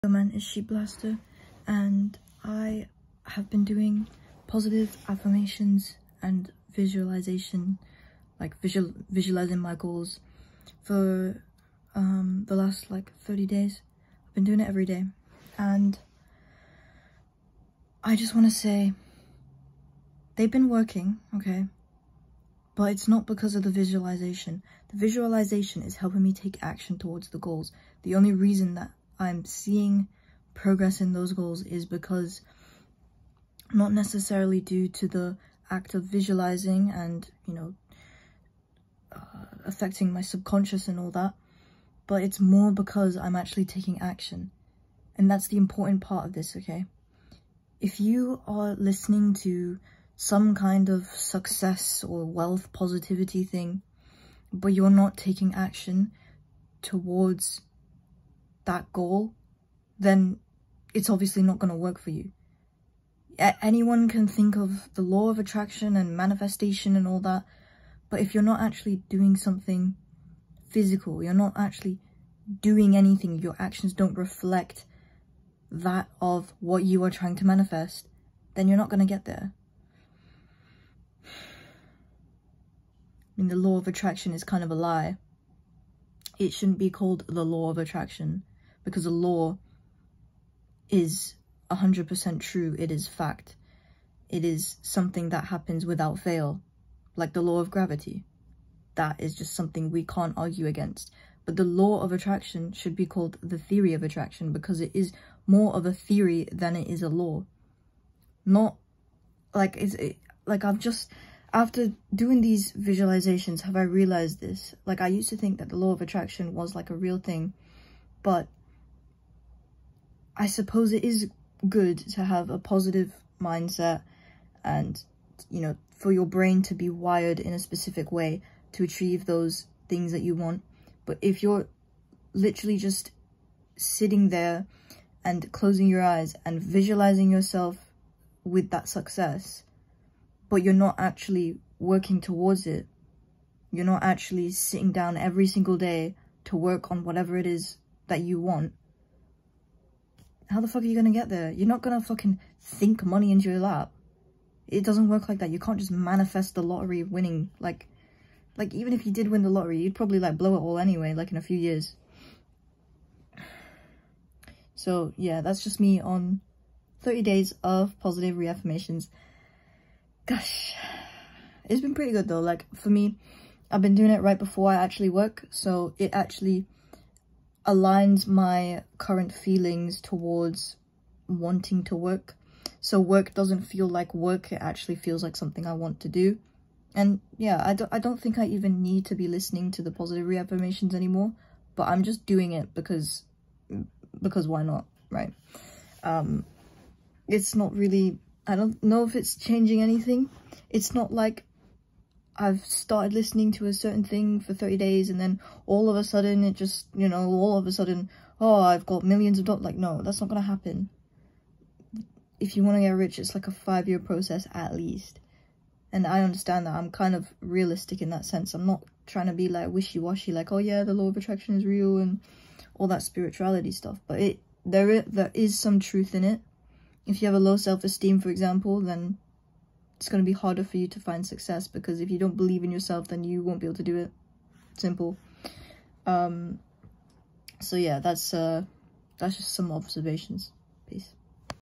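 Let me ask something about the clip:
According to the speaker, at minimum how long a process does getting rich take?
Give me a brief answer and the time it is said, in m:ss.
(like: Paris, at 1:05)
5 years, at 3:33.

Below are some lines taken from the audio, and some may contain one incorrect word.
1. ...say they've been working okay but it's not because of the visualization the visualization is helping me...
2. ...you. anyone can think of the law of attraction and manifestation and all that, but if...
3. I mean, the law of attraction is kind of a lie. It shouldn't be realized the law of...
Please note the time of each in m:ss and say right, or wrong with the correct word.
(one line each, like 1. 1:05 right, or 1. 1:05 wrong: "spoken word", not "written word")
1. 0:18 right
2. 1:02 right
3. 1:21 wrong: "called", not "realized".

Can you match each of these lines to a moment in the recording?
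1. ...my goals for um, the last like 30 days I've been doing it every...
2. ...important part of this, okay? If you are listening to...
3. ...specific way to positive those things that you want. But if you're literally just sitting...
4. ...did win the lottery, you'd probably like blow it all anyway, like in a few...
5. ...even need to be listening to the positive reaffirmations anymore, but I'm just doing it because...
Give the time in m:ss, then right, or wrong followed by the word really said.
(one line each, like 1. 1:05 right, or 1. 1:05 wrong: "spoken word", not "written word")
1. 0:09 right
2. 0:45 right
3. 2:07 wrong: "achieve", not "positive"
4. 2:39 right
5. 3:08 right.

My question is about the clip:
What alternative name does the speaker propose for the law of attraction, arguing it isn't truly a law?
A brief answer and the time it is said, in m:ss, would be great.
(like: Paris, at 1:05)
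theory of attraction, at 1:43.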